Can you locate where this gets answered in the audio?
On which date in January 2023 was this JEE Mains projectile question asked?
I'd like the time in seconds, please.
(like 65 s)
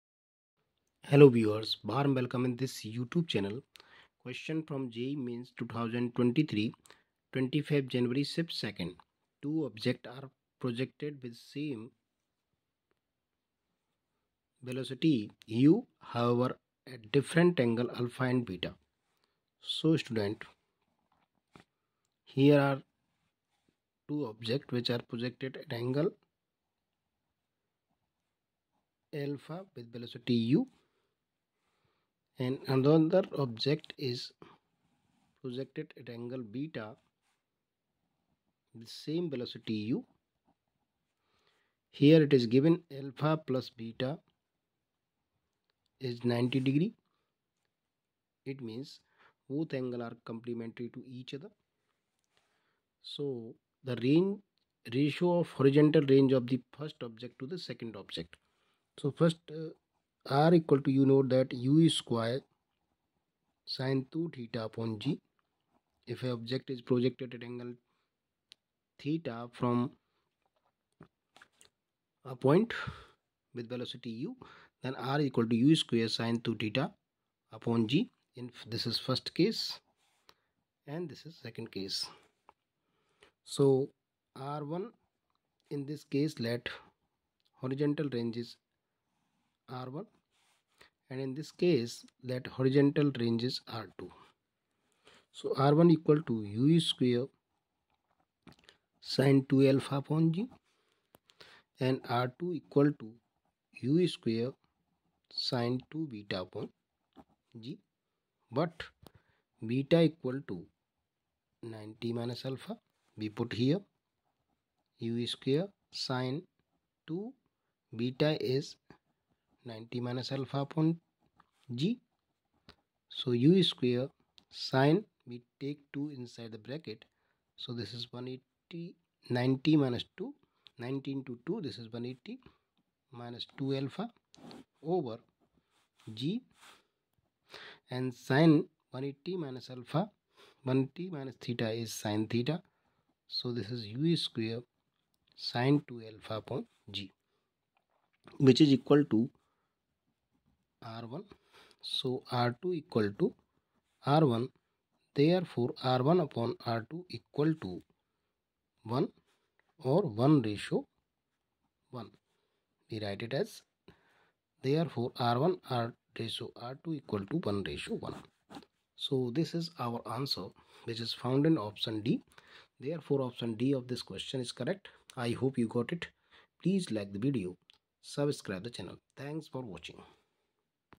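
7 s.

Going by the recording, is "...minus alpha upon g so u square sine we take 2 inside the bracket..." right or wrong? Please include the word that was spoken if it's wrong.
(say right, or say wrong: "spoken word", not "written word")
right.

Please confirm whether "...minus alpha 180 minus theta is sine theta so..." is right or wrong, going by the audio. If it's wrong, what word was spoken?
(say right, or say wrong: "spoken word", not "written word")
right.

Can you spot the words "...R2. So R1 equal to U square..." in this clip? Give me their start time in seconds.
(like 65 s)
93 s.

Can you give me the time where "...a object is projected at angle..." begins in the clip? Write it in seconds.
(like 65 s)
66 s.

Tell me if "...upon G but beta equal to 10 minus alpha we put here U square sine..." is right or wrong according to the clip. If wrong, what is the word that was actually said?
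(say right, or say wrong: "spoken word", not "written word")
wrong: "90", not "10".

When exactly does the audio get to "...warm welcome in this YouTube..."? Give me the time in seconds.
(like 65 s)
1 s.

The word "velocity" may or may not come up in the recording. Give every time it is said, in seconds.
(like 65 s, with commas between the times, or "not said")
14 s, 29 s, 39 s, 73 s.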